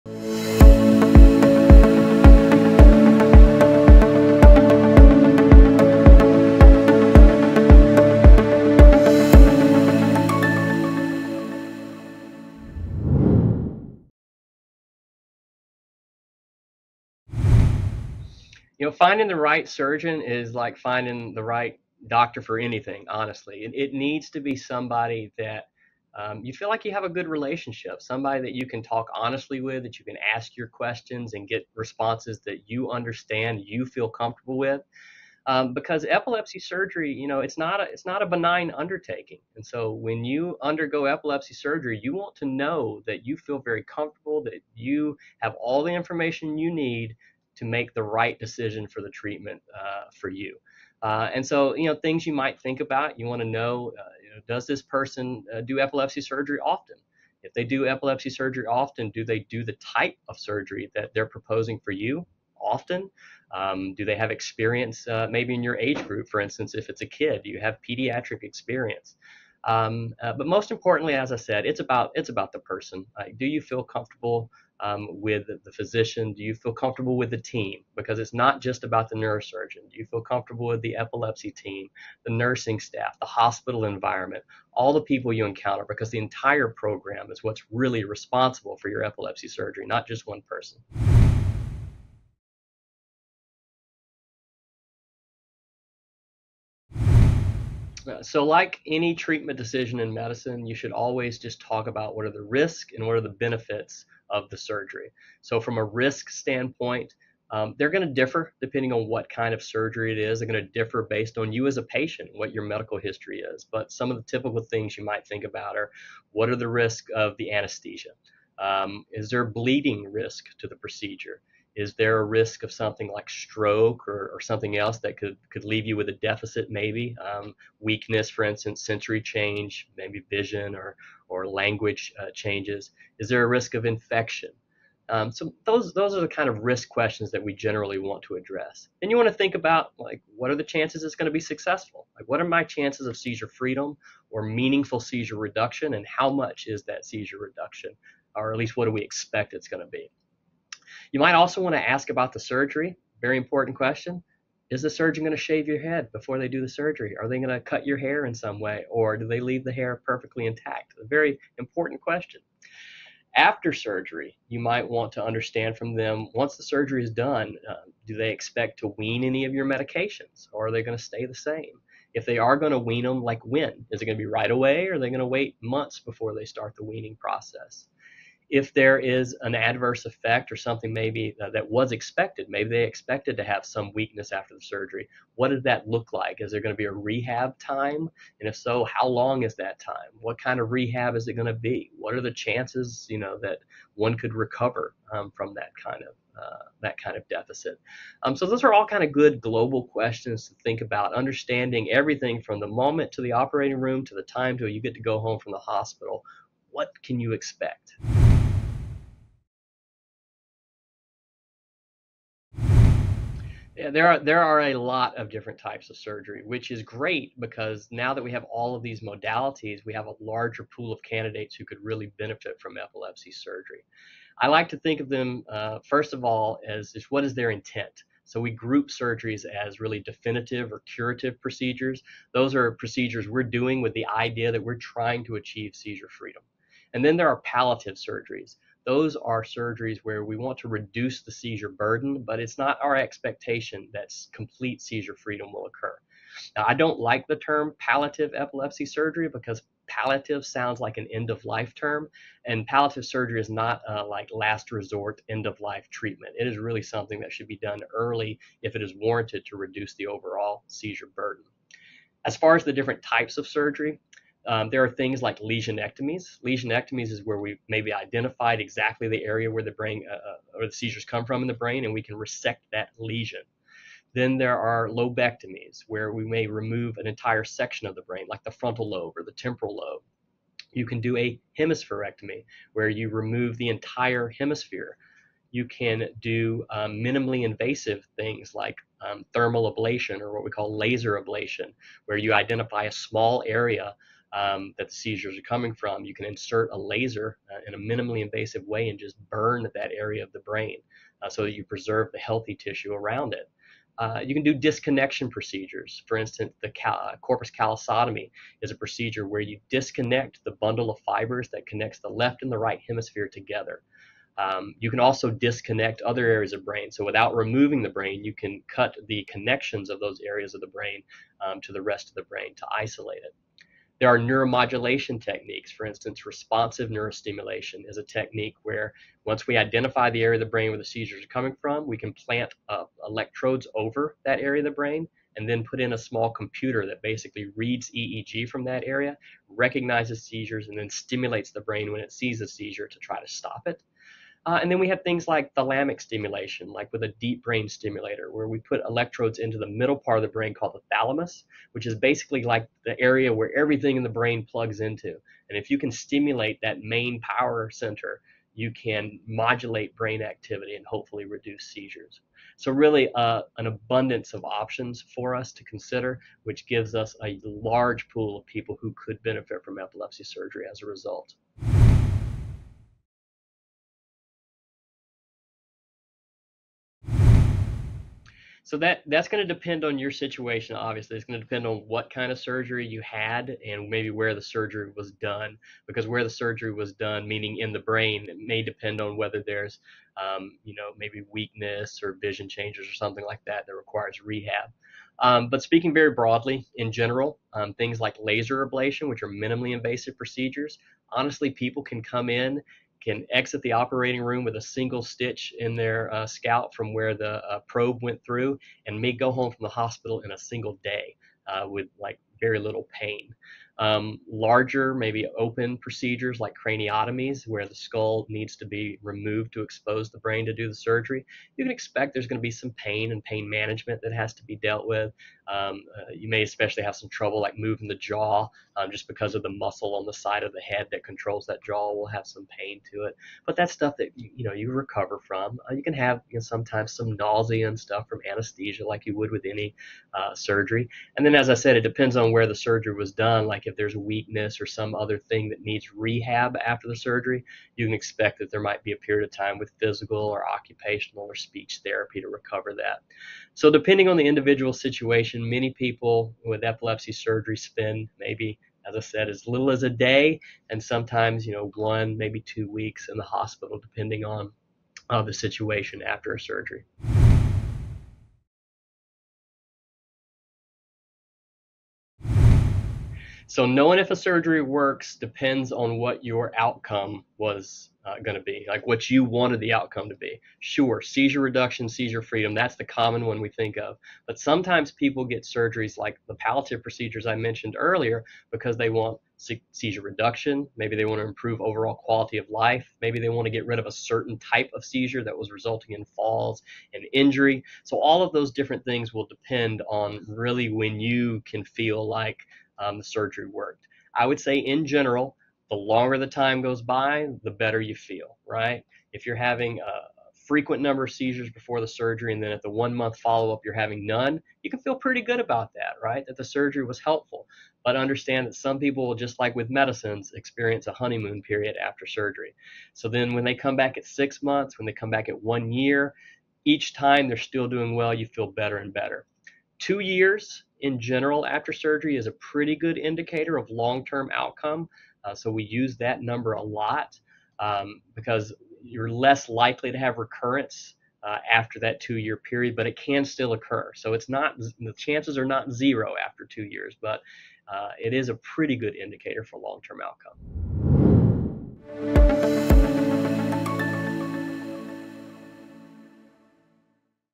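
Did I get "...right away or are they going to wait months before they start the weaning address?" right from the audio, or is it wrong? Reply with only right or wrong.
wrong.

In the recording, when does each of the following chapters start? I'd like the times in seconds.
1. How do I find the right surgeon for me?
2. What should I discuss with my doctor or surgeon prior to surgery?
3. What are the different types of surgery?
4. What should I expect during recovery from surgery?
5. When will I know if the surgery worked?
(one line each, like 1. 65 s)
1. 15 s
2. 94 s
3. 210 s
4. 374 s
5. 469 s.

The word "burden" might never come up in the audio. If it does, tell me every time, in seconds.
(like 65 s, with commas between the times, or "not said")
241 s, 261 s.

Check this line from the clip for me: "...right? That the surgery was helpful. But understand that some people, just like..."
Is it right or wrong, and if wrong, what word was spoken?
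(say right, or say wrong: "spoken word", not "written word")
right.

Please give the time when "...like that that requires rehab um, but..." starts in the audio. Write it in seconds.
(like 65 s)
393 s.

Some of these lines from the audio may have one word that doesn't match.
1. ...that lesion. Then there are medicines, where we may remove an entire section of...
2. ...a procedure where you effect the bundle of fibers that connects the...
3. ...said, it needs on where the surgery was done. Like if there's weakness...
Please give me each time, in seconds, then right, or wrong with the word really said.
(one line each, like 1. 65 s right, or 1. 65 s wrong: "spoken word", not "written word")
1. 272 s wrong: "lobectomies", not "medicines"
2. 308 s wrong: "disconnect", not "effect"
3. 441 s wrong: "depends", not "needs".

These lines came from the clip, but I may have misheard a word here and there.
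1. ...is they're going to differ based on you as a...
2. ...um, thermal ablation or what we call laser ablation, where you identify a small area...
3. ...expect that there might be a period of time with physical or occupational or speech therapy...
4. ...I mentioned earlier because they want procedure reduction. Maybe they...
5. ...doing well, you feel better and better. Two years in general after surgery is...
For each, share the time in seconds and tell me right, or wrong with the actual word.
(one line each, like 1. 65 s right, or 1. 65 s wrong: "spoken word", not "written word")
1. 110 s right
2. 289 s right
3. 447 s right
4. 487 s wrong: "seizure", not "procedure"
5. 527 s right.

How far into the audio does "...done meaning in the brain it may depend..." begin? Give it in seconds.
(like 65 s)
386 s.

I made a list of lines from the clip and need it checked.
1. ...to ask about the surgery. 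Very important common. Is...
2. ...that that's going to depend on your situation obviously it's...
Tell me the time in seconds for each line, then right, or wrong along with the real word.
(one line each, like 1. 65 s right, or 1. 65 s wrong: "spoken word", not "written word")
1. 151 s wrong: "question", not "common"
2. 378 s right.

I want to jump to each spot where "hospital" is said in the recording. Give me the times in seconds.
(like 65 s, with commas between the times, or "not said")
83 s, 205 s, 409 s, 463 s.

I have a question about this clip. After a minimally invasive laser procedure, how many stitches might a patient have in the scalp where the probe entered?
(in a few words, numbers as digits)
1.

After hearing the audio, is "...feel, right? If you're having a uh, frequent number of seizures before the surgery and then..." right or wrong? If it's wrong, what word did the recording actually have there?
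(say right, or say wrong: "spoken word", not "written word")
right.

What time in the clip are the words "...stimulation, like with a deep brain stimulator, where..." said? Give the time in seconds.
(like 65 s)
346 s.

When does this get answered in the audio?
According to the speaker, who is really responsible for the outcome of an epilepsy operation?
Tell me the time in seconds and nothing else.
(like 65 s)
86 s.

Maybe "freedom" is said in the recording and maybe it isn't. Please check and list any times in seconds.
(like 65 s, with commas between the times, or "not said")
143 s, 236 s, 245 s, 482 s.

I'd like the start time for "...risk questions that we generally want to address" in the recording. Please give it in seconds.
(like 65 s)
136 s.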